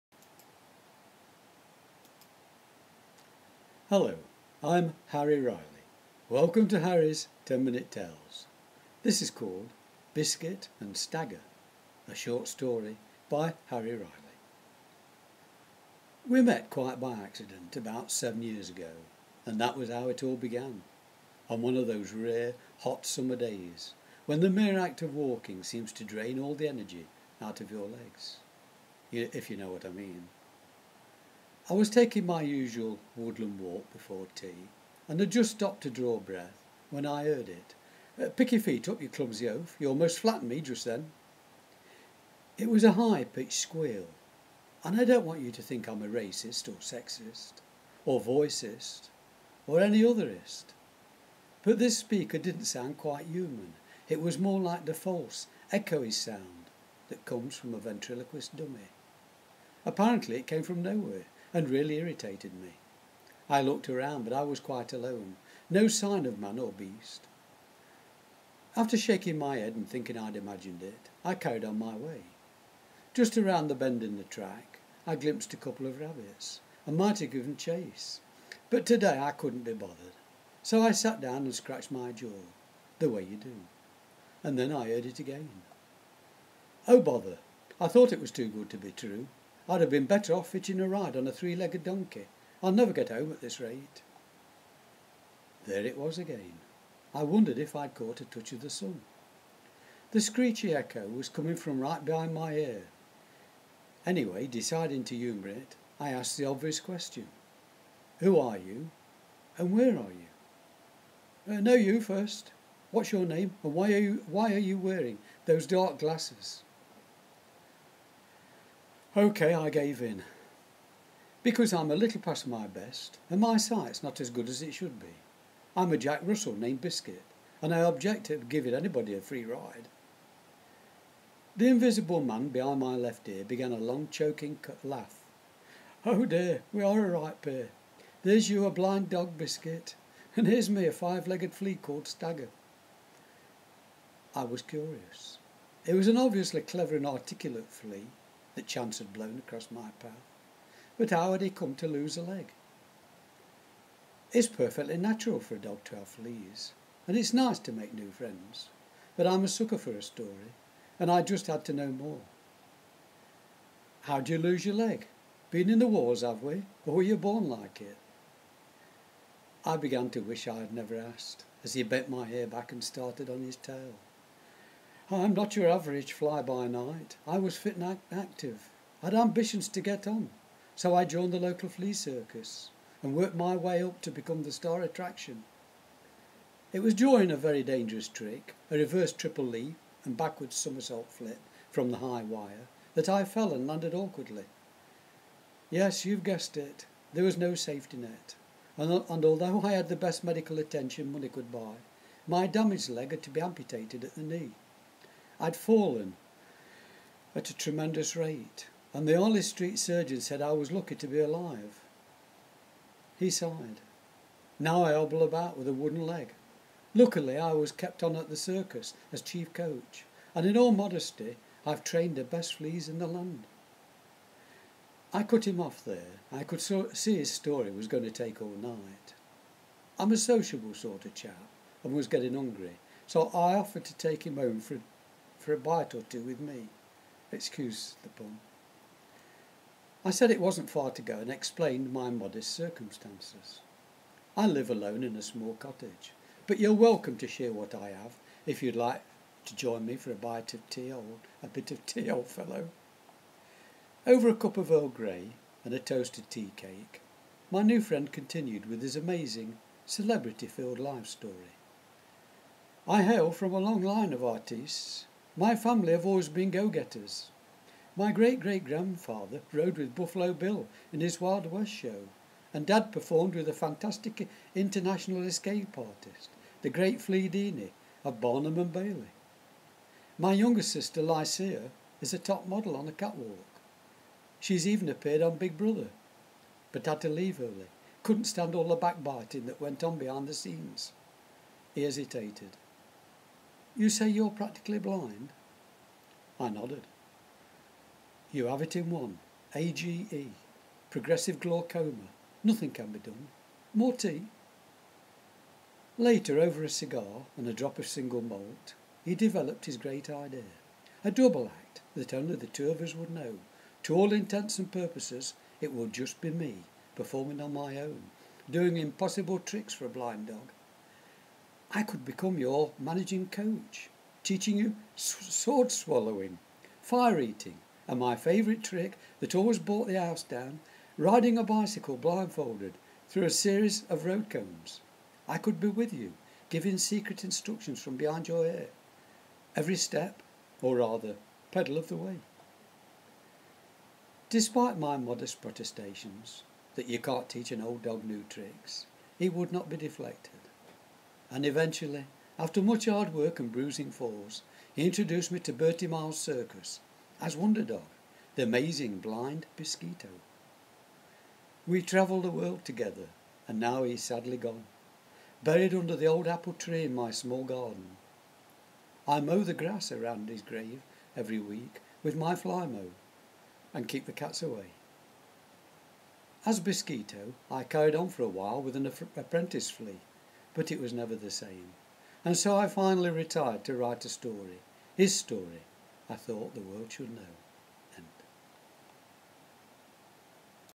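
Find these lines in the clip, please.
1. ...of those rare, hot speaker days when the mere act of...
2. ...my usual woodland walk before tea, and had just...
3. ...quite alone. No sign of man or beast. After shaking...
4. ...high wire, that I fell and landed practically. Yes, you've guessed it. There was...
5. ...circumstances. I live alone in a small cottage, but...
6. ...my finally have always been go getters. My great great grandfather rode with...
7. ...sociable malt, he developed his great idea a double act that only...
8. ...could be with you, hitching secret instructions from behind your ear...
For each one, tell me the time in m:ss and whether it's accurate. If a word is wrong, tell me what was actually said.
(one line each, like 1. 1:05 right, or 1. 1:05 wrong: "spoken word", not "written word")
1. 0:21 wrong: "summer", not "speaker"
2. 0:32 right
3. 1:04 right
4. 3:11 wrong: "awkwardly", not "practically"
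5. 4:02 right
6. 4:25 wrong: "family", not "finally"
7. 5:07 wrong: "single", not "sociable"
8. 5:35 wrong: "giving", not "hitching".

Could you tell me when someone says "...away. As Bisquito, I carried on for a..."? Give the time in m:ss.
6:14.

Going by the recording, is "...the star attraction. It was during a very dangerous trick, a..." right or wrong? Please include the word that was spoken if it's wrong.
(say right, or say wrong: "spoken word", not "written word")
right.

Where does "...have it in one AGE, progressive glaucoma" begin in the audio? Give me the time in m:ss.
4:58.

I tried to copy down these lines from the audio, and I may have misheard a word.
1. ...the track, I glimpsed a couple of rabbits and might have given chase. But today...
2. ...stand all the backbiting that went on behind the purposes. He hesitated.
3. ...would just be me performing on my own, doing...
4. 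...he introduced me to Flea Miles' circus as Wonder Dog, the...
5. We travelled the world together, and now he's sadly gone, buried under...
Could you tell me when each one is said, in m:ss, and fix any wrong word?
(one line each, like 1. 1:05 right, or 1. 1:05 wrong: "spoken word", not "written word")
1. 1:14 right
2. 4:48 wrong: "scenes", not "purposes"
3. 5:15 right
4. 5:54 wrong: "Bertie", not "Flea"
5. 6:01 right.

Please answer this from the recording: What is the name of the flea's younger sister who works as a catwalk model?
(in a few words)
Lycia.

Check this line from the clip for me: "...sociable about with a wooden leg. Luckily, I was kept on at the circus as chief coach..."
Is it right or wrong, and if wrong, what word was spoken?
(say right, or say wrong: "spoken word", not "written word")
wrong: "hobble", not "sociable".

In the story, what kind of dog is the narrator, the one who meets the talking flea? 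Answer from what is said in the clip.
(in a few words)
Jack Russell.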